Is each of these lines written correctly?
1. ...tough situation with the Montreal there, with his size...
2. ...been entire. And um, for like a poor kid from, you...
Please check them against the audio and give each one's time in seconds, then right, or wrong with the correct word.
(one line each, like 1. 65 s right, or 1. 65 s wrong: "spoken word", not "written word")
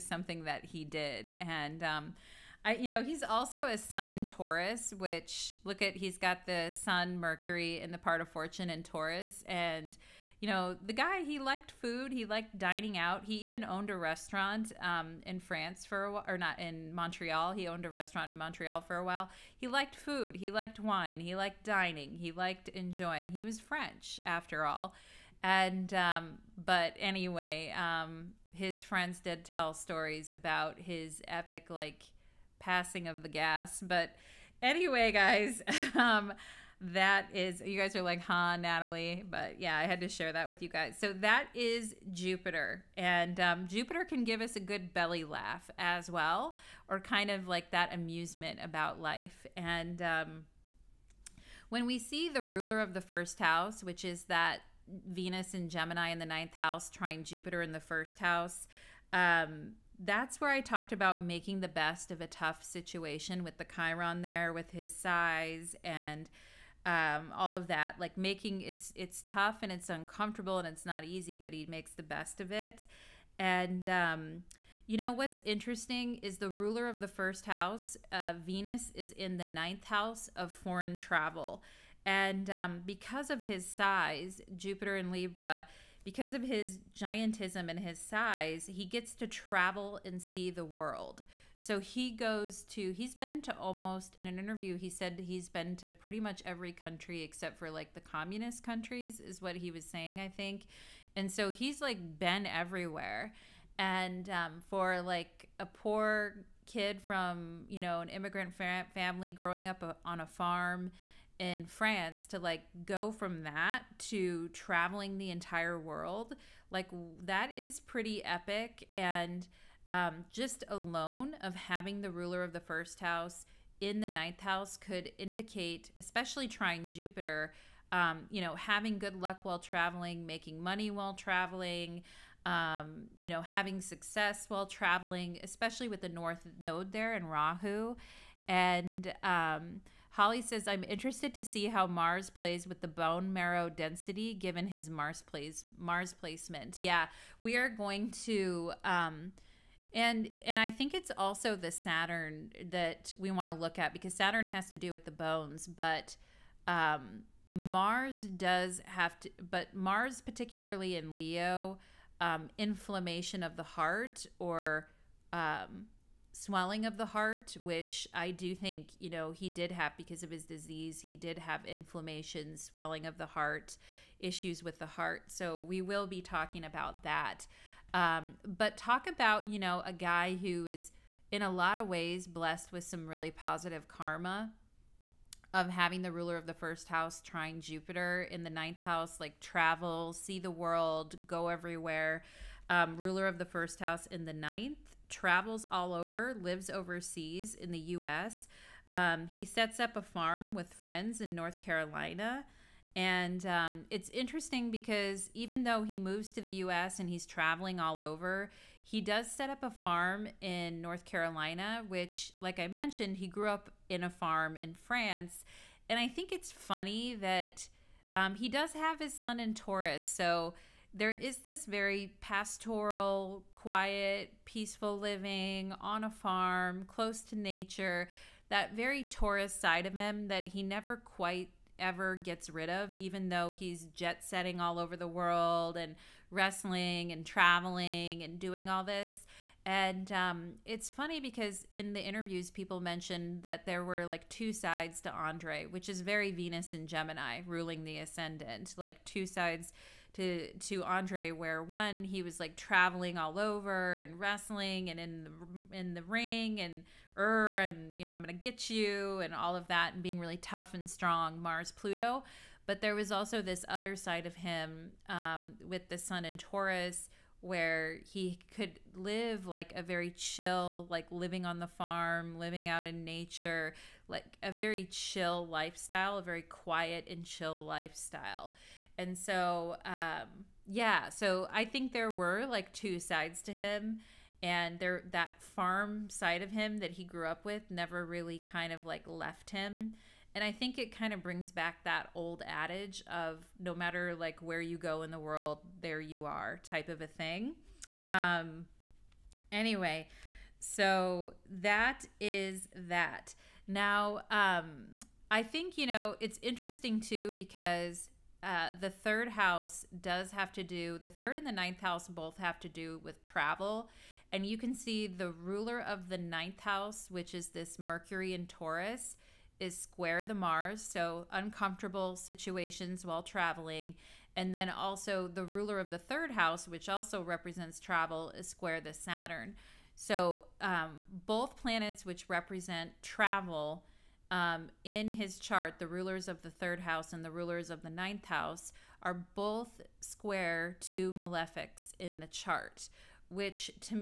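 1. 62 s wrong: "Chiron", not "Montreal"
2. 102 s wrong: "everywhere", not "entire".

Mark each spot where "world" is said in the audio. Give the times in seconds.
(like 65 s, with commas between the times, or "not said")
90 s, 115 s, 190 s, 235 s, 295 s.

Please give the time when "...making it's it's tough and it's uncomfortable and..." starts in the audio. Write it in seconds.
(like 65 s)
68 s.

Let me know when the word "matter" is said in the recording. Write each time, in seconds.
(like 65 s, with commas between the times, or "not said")
293 s.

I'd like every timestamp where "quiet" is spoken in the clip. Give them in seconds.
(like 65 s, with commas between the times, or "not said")
223 s, 276 s.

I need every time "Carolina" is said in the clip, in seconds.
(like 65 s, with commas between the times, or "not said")
201 s, 211 s.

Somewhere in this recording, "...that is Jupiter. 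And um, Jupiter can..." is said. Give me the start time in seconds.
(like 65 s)
41 s.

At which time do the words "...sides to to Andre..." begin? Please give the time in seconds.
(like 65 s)
249 s.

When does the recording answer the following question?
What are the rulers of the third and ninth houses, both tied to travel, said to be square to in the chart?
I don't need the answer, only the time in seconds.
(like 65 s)
341 s.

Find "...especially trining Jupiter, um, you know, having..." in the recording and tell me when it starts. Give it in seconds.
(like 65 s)
125 s.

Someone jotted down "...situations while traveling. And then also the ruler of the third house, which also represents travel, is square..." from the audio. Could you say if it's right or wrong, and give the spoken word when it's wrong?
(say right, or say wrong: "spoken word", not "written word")
right.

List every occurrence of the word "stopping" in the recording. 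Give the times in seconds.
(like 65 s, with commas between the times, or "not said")
not said.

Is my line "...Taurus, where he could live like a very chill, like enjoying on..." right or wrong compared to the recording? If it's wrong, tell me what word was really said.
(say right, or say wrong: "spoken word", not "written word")
wrong: "living", not "enjoying".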